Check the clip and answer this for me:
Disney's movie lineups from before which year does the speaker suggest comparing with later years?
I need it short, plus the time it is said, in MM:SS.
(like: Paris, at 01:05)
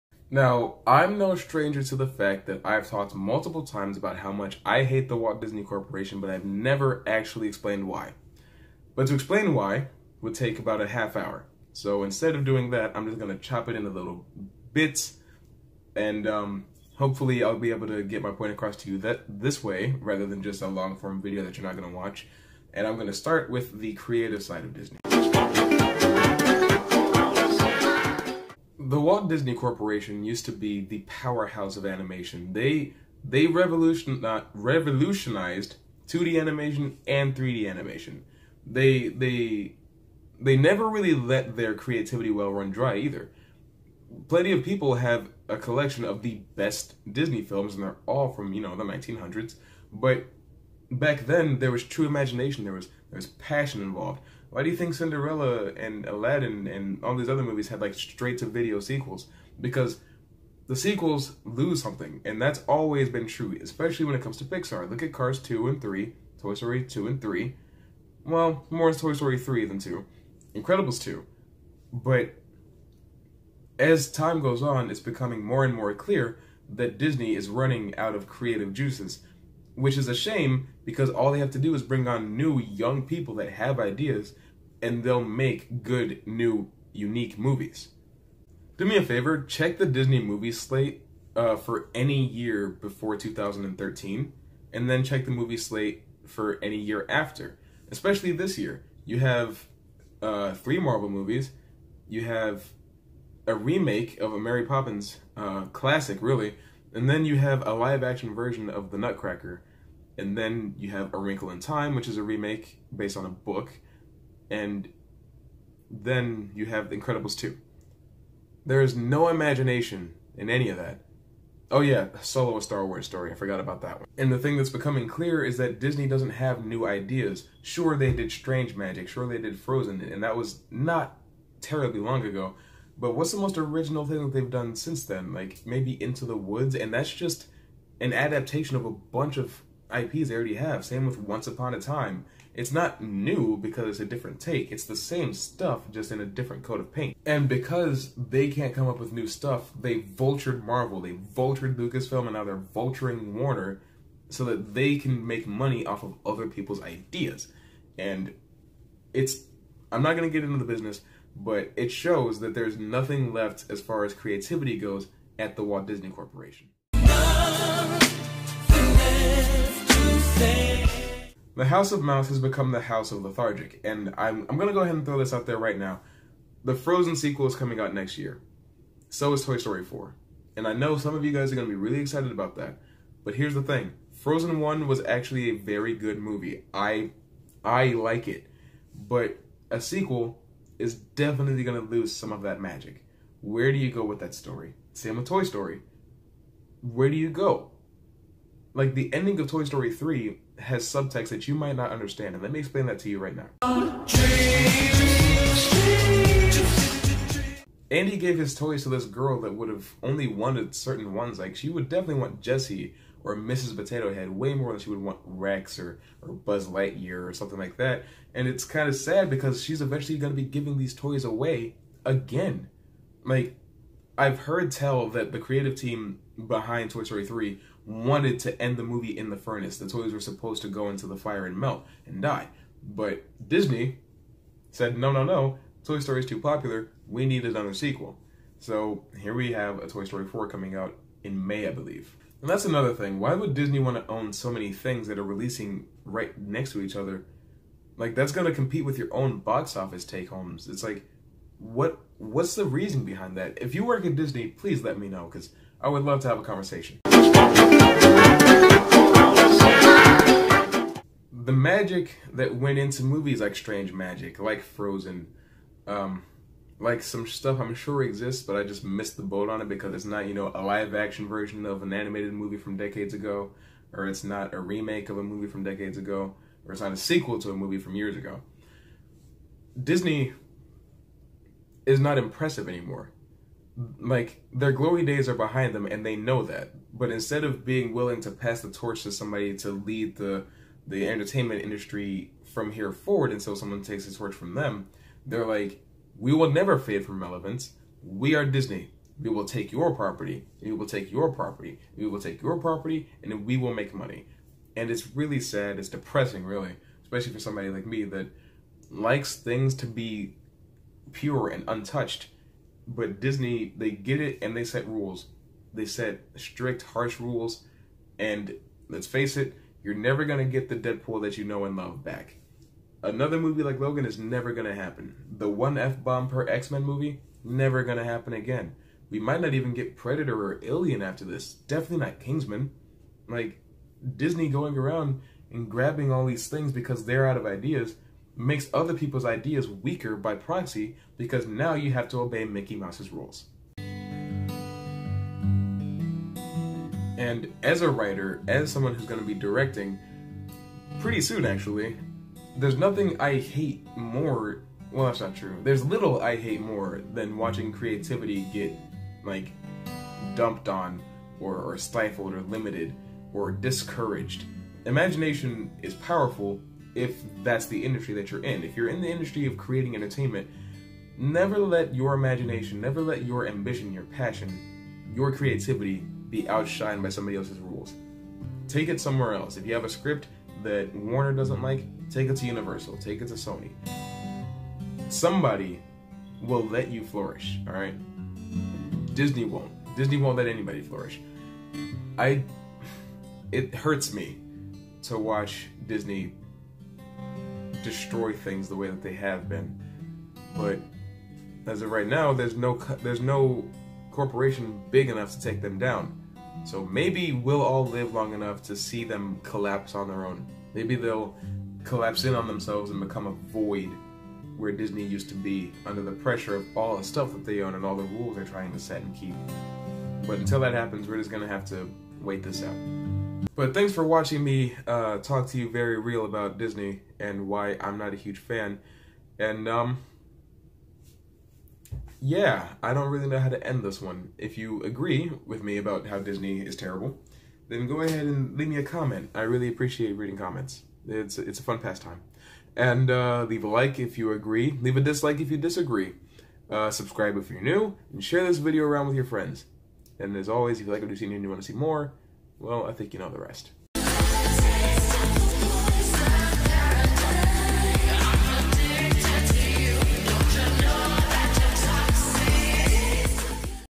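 2013, at 01:33.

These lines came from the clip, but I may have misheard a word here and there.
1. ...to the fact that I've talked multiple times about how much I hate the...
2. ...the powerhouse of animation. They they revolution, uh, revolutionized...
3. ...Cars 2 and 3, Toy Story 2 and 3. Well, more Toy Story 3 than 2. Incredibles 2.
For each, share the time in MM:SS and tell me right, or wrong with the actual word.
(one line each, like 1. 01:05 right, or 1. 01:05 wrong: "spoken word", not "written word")
1. 00:01 right
2. 00:30 right
3. 01:05 right.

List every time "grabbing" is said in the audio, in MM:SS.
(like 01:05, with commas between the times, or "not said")
05:35.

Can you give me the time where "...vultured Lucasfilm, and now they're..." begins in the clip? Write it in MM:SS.
02:31.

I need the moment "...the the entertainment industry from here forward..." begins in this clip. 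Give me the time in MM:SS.
04:50.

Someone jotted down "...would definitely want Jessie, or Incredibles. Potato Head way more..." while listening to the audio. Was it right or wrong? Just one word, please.
wrong.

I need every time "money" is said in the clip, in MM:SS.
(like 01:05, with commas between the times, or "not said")
02:35, 05:03.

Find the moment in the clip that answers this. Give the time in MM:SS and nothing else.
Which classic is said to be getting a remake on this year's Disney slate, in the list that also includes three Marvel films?
01:44.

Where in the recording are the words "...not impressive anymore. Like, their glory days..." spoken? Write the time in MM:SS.
04:41.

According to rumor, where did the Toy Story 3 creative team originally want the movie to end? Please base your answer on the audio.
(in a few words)
In the furnace.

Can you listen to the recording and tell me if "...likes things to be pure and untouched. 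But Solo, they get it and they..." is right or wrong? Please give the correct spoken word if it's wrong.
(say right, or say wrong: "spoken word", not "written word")
wrong: "Disney", not "Solo".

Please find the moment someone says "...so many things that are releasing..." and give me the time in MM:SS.
04:04.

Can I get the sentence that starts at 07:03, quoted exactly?
But thanks for watching me uh, talk to you very real about Disney and why I'm not a huge fan.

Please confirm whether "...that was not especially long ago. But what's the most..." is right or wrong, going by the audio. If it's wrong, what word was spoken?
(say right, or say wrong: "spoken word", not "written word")
wrong: "terribly", not "especially".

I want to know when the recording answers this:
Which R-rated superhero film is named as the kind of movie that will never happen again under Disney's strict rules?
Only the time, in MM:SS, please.
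05:23.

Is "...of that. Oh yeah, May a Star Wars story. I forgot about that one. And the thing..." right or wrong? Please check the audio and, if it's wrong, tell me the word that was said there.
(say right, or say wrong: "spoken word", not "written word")
wrong: "Solo", not "May".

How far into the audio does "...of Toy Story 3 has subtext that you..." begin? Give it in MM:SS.
03:19.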